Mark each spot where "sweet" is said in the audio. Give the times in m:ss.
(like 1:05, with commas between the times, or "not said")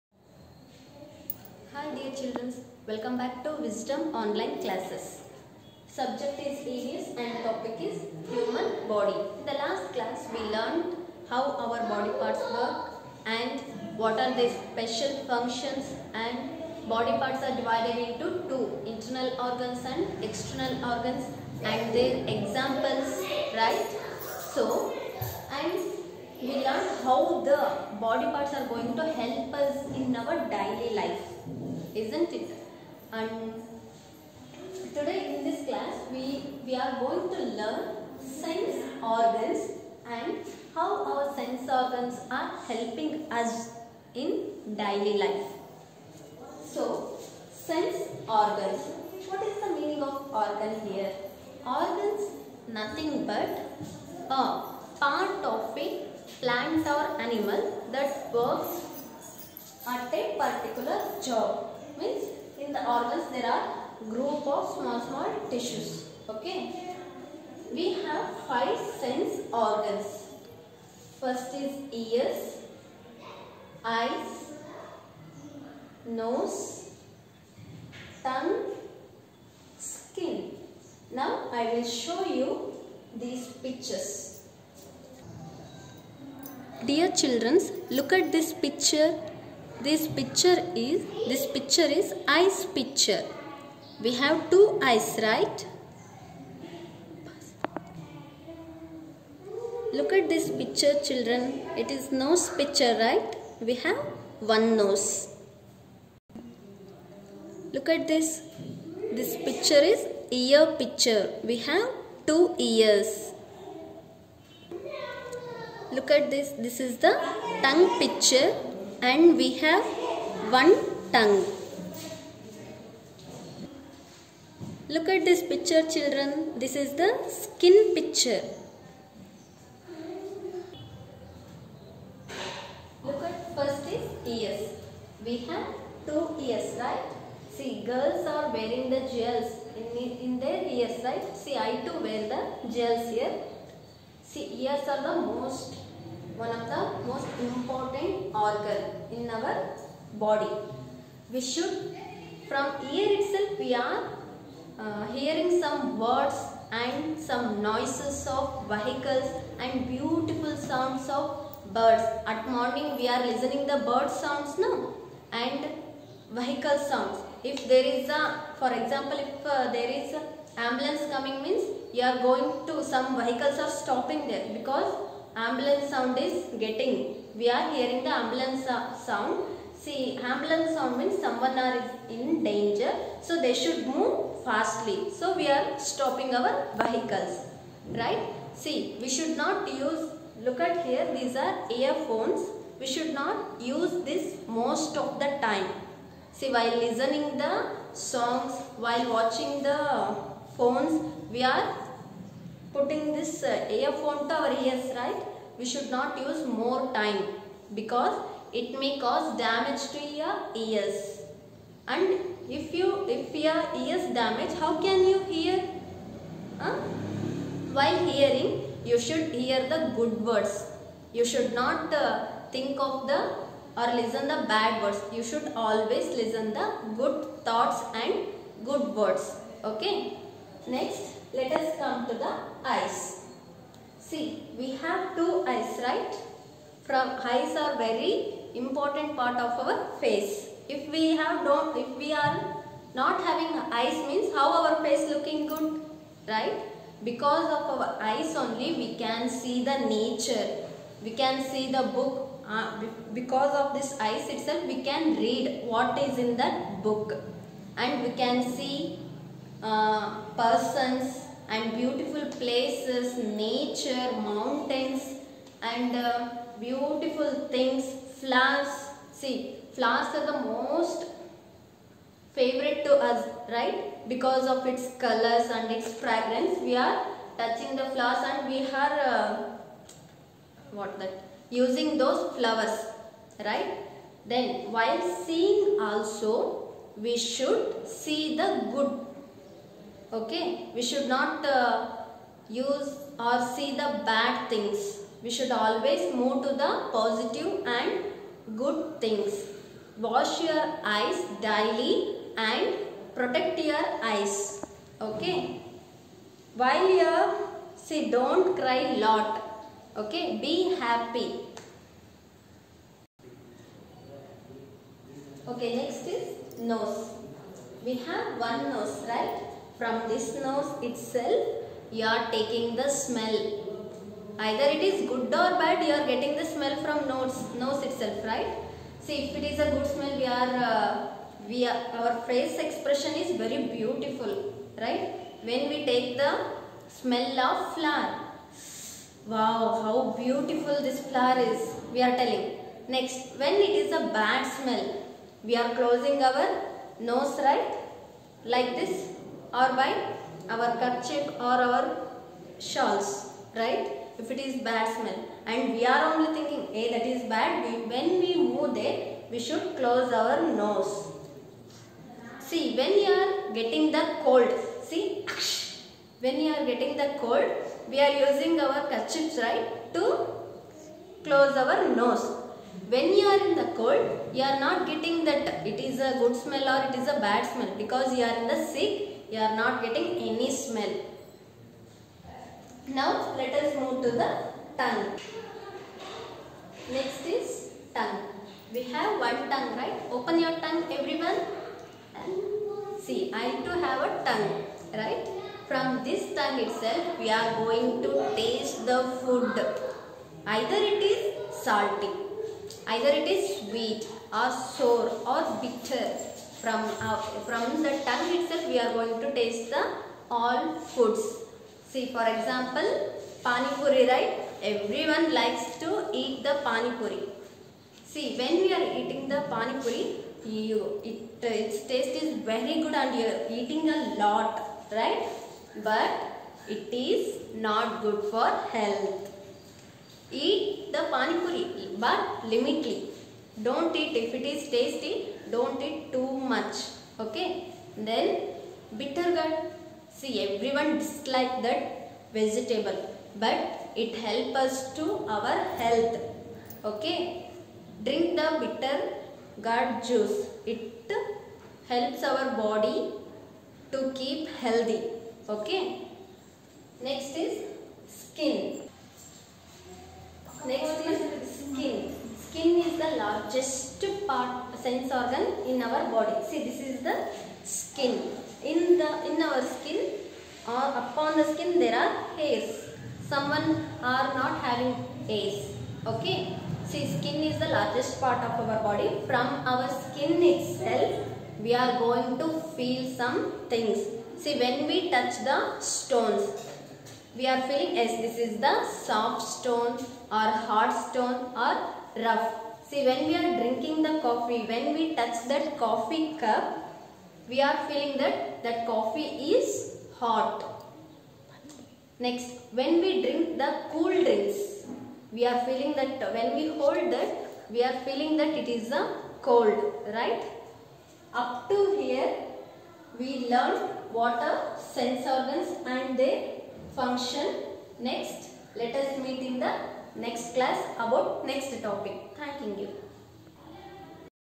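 6:43.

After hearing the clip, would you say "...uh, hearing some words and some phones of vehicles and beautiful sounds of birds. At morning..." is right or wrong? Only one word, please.
wrong.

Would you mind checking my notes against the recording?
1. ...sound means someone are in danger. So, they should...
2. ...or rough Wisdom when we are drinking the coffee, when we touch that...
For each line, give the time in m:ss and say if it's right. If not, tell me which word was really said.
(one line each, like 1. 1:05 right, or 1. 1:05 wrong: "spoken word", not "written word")
1. 3:00 right
2. 8:11 wrong: "See", not "Wisdom".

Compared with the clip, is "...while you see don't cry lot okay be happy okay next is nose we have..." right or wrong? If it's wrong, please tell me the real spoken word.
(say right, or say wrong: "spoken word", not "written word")
right.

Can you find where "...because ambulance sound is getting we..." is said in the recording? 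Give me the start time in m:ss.
2:54.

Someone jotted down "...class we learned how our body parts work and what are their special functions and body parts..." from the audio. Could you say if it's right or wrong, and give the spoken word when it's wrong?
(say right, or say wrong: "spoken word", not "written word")
right.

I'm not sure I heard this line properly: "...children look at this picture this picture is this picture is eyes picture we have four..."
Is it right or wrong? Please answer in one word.
wrong.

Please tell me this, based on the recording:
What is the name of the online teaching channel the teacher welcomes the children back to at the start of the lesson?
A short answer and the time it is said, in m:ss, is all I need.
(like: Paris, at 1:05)
Wisdom Online Classes, at 0:03.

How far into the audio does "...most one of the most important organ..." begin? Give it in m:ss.
2:25.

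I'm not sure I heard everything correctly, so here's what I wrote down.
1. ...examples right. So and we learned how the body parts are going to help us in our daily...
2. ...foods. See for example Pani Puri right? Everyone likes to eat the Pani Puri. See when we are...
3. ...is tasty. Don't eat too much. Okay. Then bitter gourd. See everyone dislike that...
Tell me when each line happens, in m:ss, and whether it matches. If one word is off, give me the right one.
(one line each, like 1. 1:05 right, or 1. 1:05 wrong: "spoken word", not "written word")
1. 0:22 right
2. 6:50 right
3. 7:14 right.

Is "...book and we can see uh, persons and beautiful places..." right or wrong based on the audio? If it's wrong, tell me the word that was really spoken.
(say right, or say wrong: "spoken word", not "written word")
right.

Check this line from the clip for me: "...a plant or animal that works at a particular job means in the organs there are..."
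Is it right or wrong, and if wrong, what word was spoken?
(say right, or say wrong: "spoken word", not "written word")
right.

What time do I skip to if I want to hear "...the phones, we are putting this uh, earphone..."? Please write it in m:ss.
3:19.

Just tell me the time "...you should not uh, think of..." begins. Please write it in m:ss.
3:41.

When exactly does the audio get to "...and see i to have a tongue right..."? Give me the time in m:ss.
6:32.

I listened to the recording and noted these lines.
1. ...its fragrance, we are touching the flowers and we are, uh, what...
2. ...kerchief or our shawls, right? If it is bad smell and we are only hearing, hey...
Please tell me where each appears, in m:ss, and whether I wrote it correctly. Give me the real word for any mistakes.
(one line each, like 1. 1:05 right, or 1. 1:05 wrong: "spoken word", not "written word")
1. 4:35 right
2. 5:50 wrong: "thinking", not "hearing".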